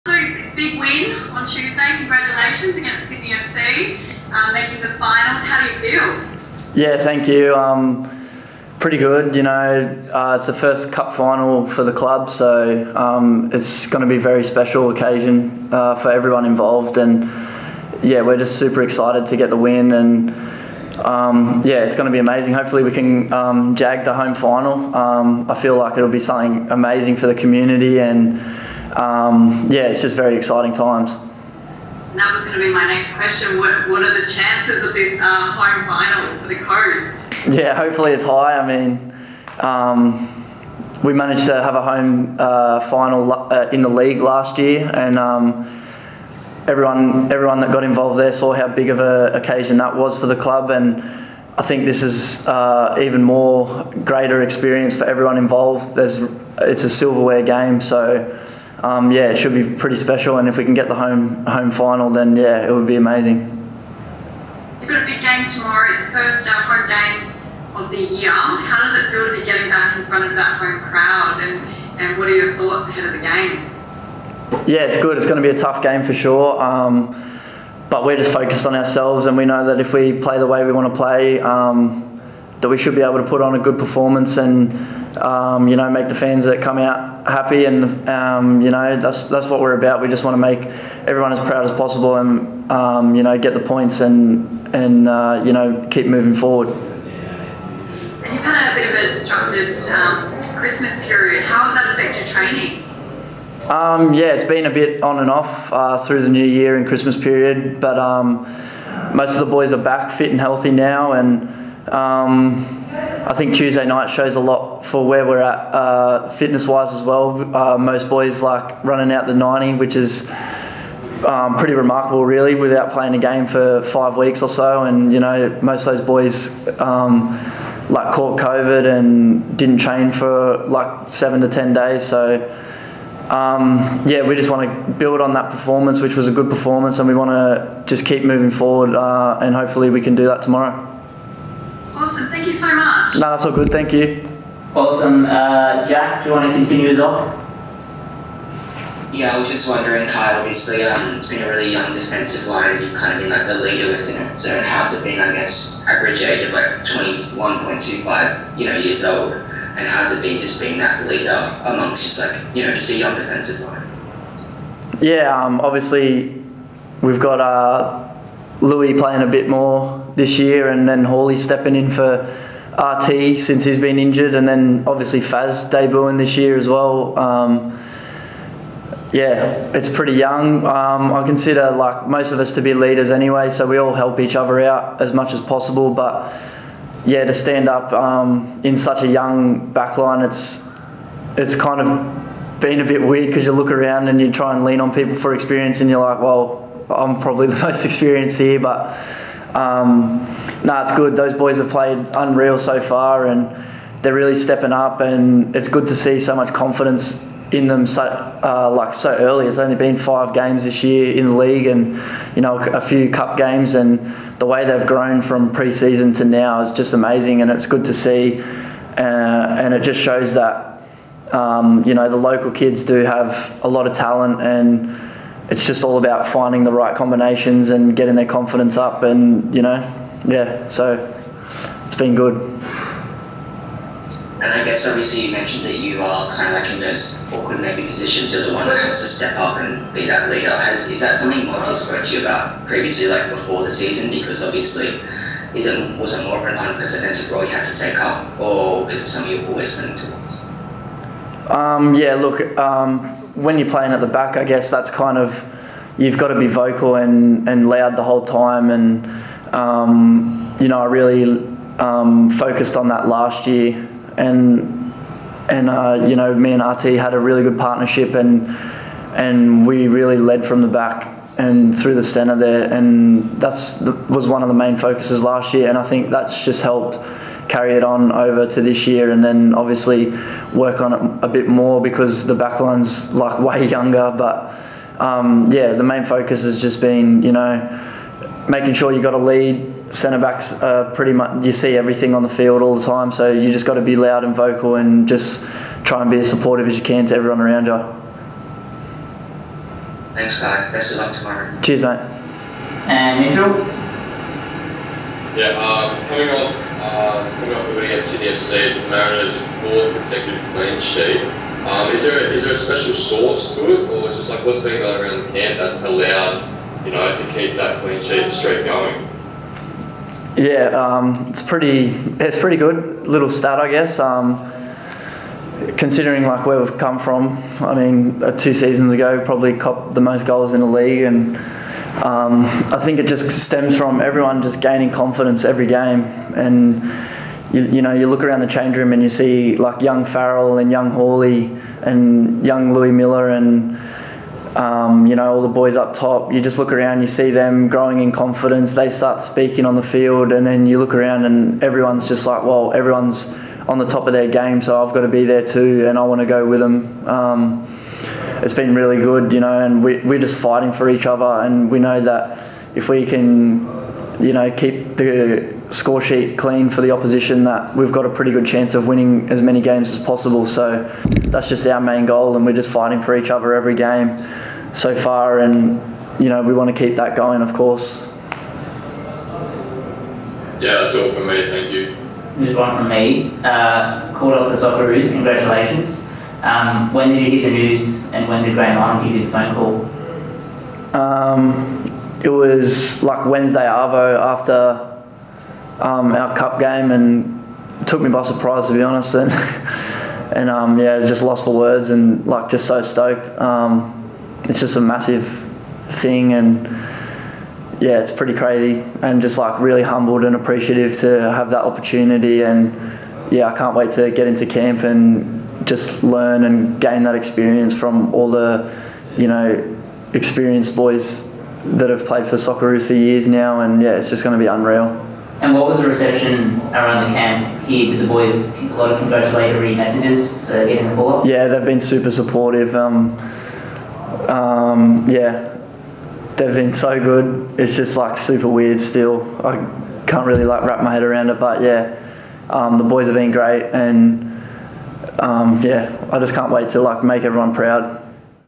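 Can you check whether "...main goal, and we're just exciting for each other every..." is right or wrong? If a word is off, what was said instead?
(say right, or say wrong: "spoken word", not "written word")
wrong: "fighting", not "exciting".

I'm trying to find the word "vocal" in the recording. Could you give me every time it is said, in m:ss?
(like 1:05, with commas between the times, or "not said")
4:16, 4:54.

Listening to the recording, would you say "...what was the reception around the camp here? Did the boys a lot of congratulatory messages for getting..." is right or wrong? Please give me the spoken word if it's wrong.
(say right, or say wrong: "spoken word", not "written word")
right.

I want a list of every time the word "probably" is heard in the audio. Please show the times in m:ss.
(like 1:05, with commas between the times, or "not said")
3:17, 5:29.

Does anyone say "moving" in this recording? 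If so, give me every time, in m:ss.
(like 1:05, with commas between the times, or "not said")
1:36, 2:18.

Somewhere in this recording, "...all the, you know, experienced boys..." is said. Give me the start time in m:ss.
6:58.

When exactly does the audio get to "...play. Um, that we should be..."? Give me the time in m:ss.
1:20.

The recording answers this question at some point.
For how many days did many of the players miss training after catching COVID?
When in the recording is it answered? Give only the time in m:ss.
2:11.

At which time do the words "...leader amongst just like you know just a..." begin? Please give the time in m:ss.
2:41.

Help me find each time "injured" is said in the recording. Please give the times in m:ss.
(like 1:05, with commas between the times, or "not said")
2:53.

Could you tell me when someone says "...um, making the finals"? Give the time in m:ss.
0:04.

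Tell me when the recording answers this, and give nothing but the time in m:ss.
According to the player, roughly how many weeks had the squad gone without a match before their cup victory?
2:03.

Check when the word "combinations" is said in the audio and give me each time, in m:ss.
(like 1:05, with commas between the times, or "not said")
3:46.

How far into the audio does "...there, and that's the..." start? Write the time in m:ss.
4:32.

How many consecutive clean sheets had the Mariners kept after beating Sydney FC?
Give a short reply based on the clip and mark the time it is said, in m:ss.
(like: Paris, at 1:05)
4, at 5:09.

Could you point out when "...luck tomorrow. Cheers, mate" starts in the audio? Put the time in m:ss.
5:00.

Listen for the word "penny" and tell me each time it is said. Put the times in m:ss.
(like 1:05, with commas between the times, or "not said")
not said.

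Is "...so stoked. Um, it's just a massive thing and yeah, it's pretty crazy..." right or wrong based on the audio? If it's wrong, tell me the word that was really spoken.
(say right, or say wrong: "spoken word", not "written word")
right.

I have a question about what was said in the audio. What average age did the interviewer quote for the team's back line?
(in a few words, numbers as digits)
21.25.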